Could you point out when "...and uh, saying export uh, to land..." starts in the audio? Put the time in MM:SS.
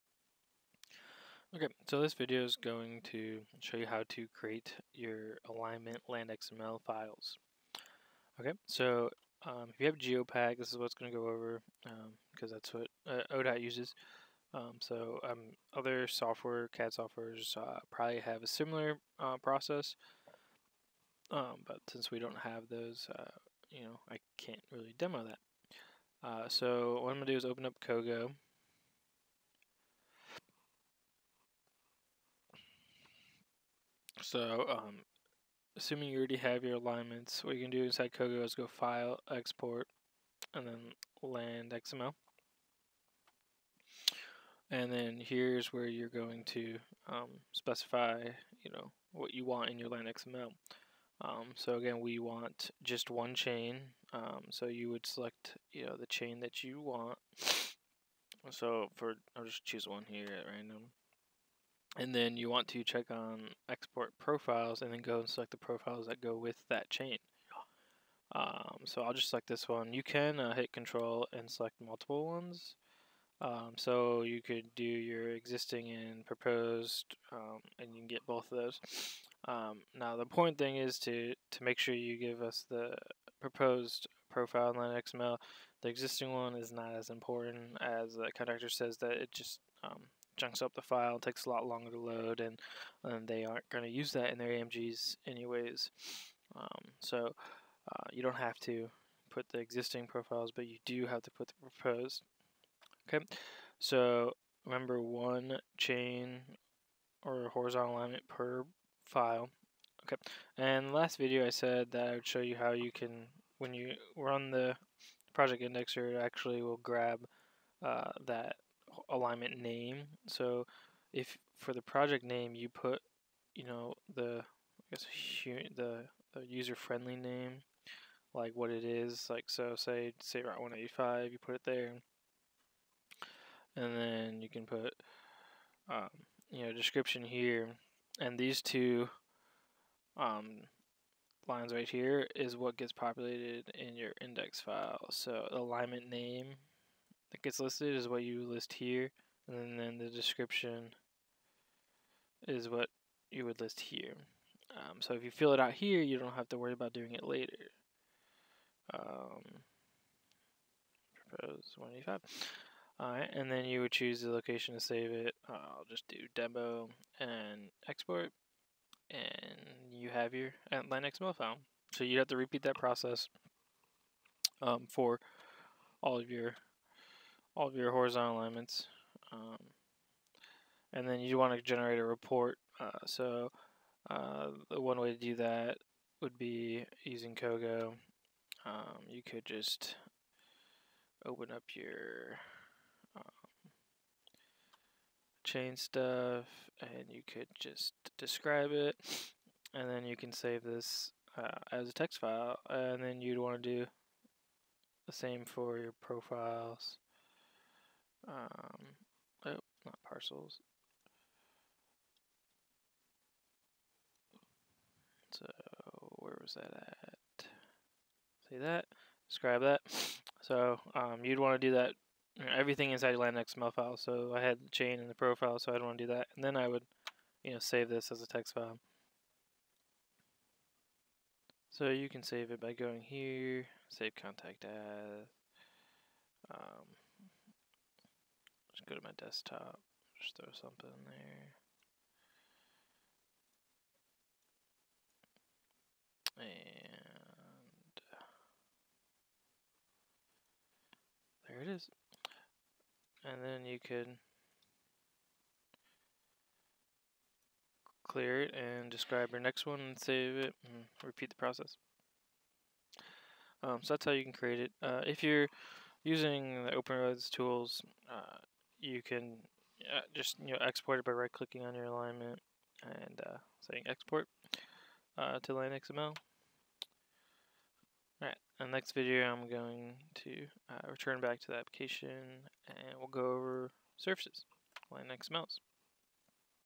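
04:32.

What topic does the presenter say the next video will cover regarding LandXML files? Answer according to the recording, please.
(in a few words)
surfaces.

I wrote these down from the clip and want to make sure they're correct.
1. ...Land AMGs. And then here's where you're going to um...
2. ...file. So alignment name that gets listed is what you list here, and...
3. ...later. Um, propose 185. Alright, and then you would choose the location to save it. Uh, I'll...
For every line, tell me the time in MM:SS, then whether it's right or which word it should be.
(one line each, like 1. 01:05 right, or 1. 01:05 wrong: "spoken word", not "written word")
1. 00:41 wrong: "XML", not "AMGs"
2. 02:24 right
3. 02:37 right.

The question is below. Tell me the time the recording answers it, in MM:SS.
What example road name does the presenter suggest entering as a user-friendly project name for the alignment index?
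02:10.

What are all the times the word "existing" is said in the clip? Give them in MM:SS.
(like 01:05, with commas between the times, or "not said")
01:15, 01:25, 01:39.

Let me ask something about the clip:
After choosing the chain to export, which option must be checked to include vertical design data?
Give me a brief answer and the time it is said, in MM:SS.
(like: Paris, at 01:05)
export profiles, at 01:03.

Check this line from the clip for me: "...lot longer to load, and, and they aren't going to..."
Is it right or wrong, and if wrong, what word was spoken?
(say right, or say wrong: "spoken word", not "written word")
right.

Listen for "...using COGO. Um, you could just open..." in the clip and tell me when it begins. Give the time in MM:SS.
03:07.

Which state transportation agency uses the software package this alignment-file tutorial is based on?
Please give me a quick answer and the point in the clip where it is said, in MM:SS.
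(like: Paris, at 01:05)
ODOT, at 00:13.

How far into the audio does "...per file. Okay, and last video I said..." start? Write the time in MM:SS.
01:48.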